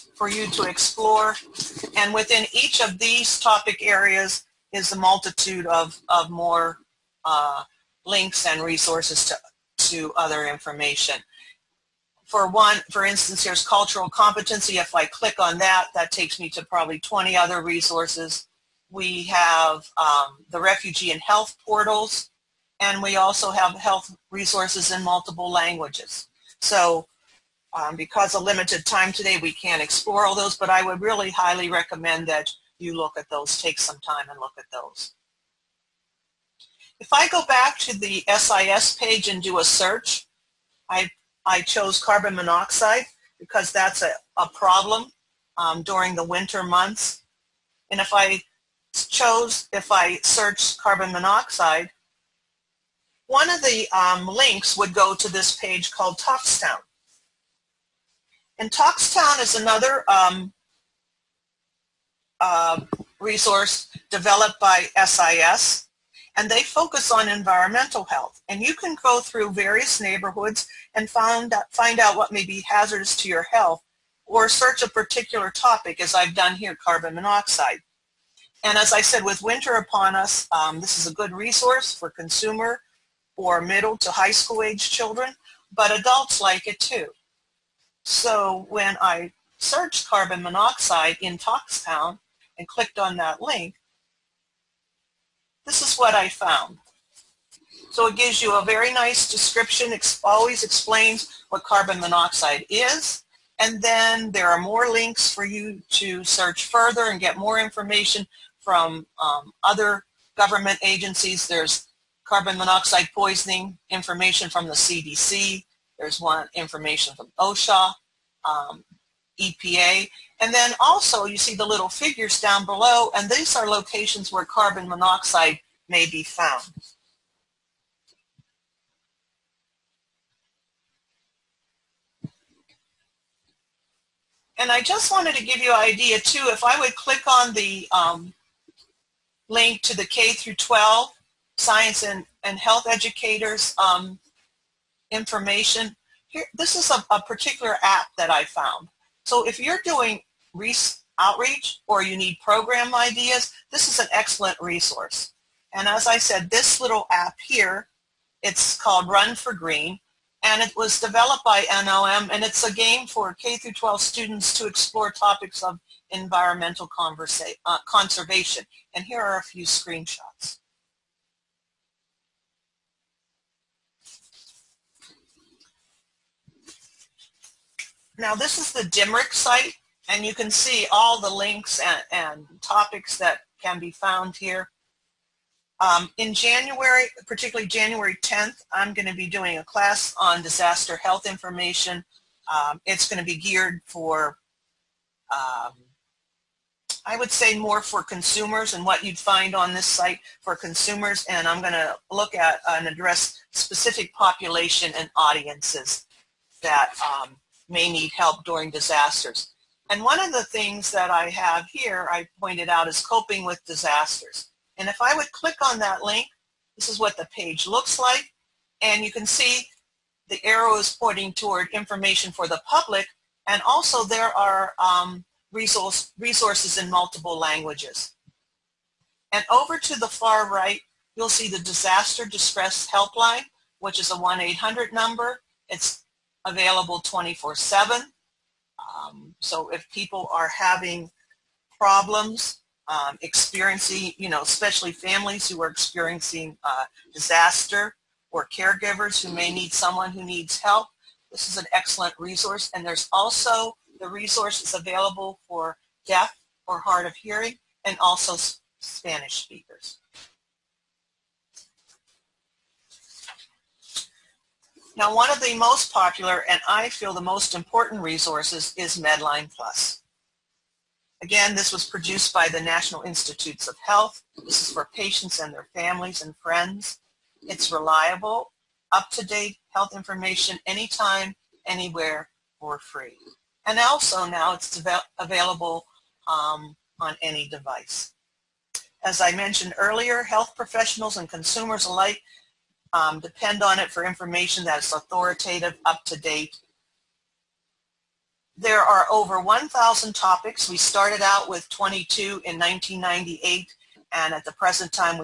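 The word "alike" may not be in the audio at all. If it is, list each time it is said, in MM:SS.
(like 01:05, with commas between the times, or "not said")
04:51.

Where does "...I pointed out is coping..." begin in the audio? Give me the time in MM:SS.
03:32.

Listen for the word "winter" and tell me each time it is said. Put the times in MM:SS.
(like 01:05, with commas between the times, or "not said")
00:46, 01:19.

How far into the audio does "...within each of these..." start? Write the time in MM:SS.
00:02.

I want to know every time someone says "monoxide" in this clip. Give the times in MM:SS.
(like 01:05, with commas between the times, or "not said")
00:42, 00:51, 01:17, 01:30, 01:42, 01:52, 02:04.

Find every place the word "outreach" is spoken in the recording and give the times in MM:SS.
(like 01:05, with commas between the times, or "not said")
02:31.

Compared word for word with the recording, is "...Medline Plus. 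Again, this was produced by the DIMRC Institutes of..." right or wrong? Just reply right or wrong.
wrong.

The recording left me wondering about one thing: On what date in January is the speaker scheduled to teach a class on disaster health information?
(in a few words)
January 10th.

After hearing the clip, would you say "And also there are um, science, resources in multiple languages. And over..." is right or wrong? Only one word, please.
wrong.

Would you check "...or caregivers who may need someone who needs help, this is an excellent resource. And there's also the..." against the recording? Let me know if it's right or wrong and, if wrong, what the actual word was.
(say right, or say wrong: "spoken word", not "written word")
right.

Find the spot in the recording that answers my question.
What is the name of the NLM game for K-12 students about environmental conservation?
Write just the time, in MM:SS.
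02:39.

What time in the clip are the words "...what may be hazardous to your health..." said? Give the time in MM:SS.
01:12.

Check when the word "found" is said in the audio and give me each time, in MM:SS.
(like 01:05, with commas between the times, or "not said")
01:36, 02:06, 02:28, 03:03.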